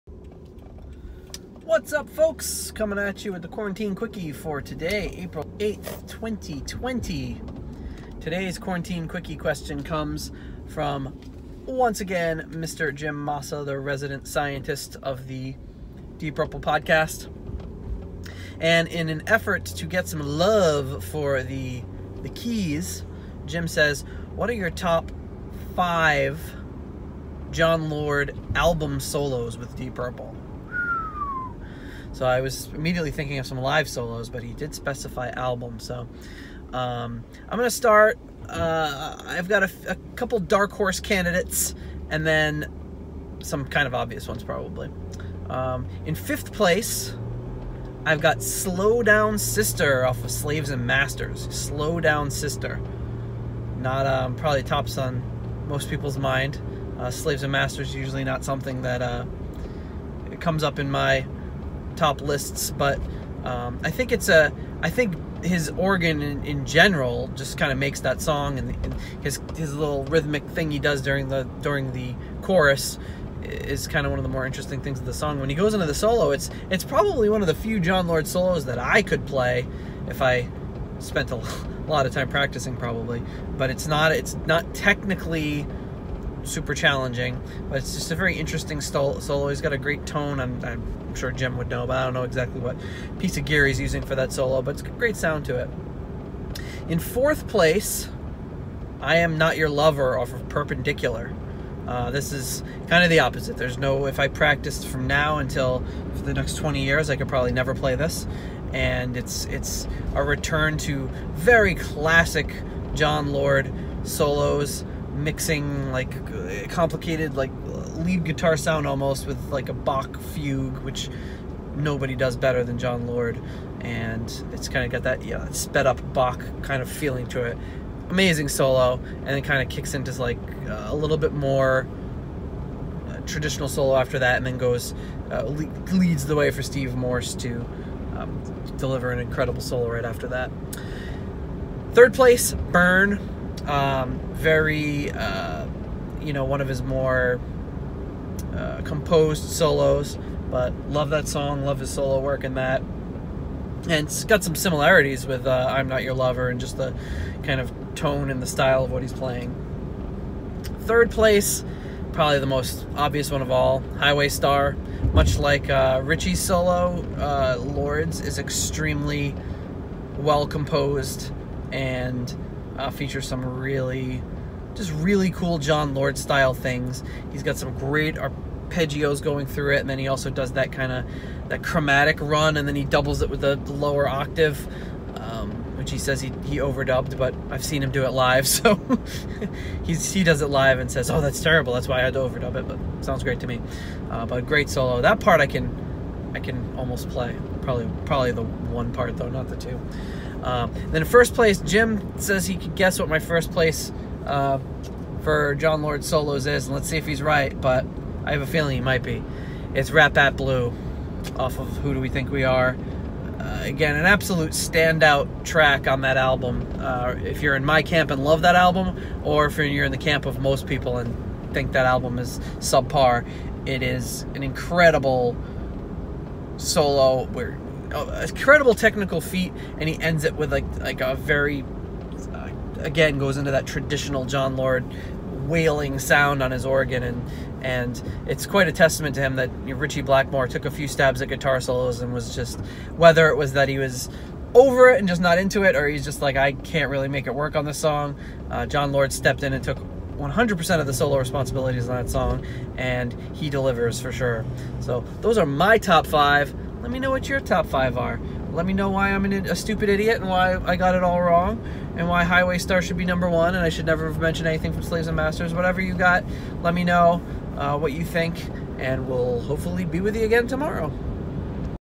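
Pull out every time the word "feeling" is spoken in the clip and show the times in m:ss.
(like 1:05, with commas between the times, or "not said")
2:06, 3:28.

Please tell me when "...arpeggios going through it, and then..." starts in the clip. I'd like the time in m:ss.
2:58.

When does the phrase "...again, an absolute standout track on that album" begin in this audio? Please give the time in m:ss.
3:33.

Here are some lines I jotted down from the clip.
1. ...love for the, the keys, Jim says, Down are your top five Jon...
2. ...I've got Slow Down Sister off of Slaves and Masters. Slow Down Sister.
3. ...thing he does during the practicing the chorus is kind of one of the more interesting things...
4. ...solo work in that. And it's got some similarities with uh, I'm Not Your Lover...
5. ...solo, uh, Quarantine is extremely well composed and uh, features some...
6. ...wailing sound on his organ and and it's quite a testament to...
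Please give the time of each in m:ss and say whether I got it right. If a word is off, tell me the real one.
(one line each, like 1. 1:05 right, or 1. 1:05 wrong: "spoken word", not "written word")
1. 0:20 wrong: "What", not "Down"
2. 0:48 right
3. 1:10 wrong: "during", not "practicing"
4. 2:31 right
5. 2:46 wrong: "Lords", not "Quarantine"
6. 3:55 right.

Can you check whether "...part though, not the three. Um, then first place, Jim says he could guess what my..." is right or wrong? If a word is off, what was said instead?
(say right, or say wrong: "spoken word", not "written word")
wrong: "two", not "three".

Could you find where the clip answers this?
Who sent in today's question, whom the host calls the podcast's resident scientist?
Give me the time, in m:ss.
0:12.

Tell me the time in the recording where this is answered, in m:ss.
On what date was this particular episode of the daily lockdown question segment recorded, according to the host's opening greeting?
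0:05.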